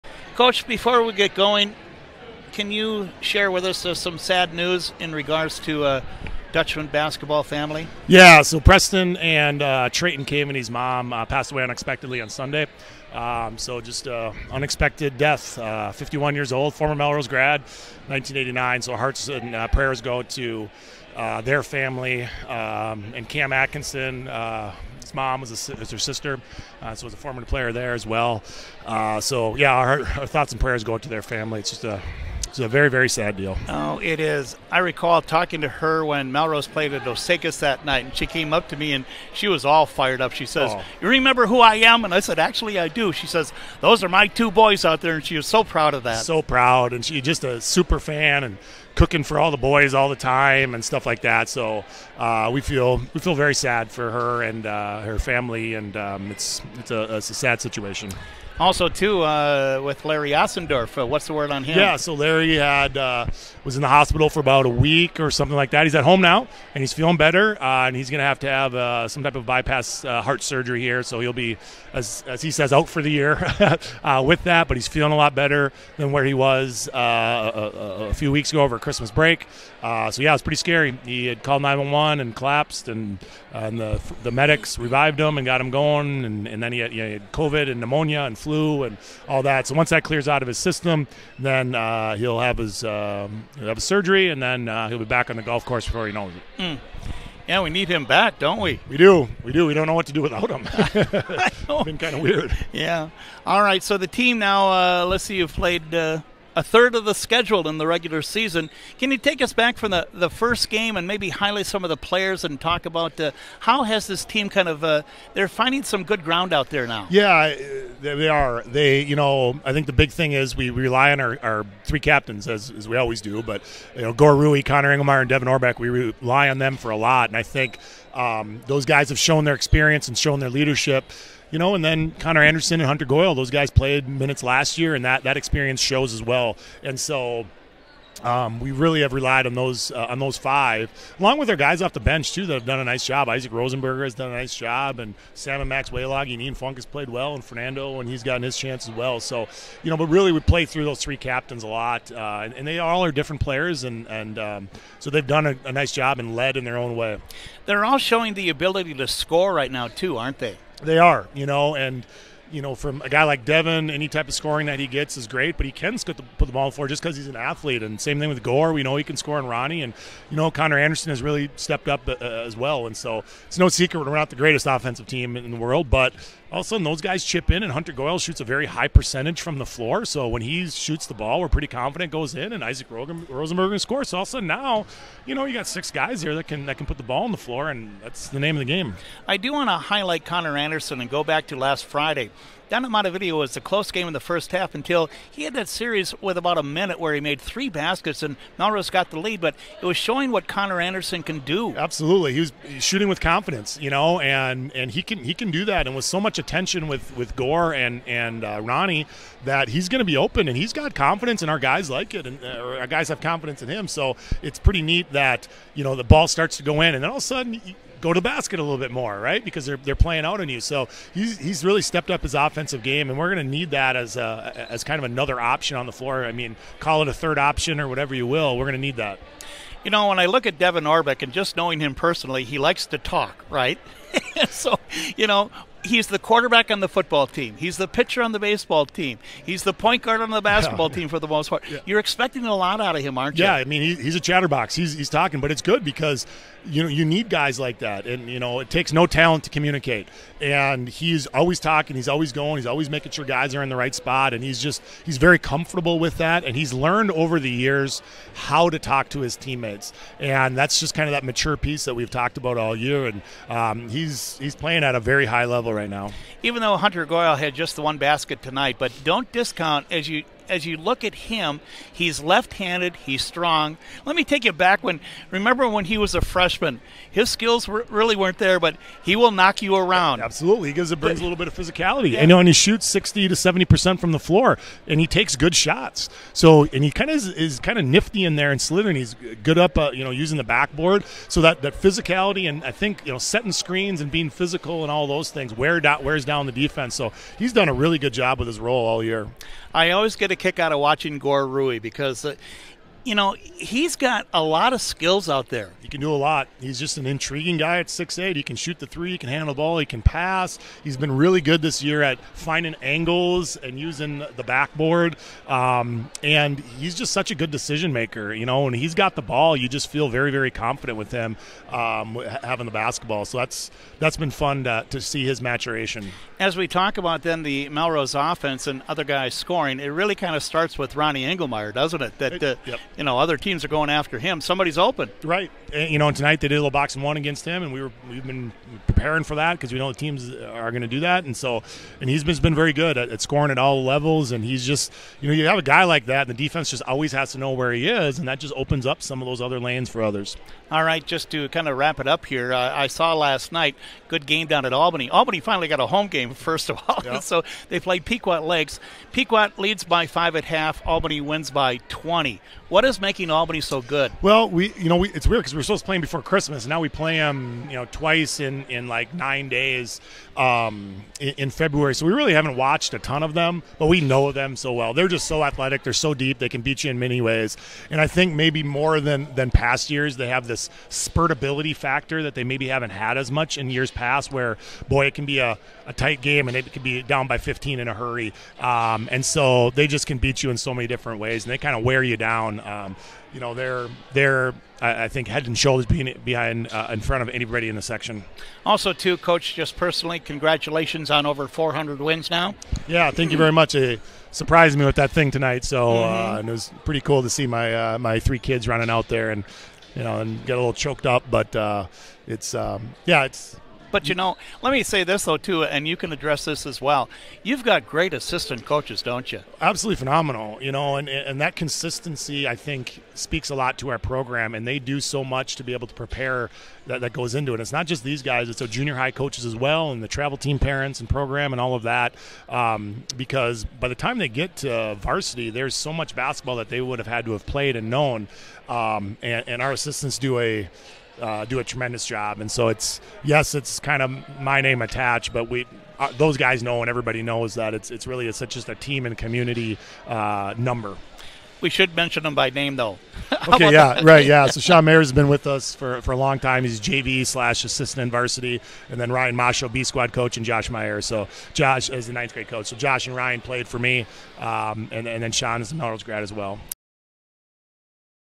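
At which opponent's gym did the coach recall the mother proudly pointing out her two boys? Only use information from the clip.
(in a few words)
Osakis.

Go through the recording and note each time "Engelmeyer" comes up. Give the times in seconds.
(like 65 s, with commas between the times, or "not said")
124 s, 331 s.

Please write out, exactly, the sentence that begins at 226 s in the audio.
I mean, call it a third option or whatever you will.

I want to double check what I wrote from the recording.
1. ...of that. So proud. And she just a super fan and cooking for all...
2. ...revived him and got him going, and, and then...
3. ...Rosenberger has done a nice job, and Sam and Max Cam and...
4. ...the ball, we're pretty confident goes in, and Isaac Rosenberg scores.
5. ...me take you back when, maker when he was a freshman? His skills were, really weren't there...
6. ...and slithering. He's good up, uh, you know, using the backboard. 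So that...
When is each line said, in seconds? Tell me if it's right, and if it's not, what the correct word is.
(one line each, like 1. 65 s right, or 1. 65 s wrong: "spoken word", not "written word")
1. 45 s right
2. 84 s right
3. 143 s wrong: "Waylog", not "Cam"
4. 181 s right
5. 274 s wrong: "remember", not "maker"
6. 288 s right.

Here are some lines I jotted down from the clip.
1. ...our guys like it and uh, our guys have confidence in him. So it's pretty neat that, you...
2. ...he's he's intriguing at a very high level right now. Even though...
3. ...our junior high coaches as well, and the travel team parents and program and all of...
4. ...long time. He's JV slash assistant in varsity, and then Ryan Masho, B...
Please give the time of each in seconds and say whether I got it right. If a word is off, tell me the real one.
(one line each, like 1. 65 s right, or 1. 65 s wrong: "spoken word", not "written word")
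1. 211 s right
2. 263 s wrong: "playing", not "intriguing"
3. 428 s right
4. 456 s right.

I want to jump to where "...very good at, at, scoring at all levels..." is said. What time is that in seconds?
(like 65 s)
342 s.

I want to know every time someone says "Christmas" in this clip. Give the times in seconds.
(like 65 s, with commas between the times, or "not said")
78 s, 366 s.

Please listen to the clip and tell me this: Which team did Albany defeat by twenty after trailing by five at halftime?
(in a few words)
Pequot Lakes.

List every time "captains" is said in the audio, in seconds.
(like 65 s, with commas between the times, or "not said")
121 s, 151 s.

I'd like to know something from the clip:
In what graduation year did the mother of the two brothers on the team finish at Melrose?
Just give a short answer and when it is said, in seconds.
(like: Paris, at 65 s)
1989, at 18 s.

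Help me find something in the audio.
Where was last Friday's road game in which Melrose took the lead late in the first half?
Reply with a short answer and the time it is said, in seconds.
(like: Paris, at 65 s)
Montevideo, at 192 s.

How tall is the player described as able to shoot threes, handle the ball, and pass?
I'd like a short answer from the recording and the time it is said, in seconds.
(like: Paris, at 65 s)
6'8, at 307 s.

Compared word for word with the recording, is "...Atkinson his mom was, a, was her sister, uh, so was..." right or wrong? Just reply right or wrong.
right.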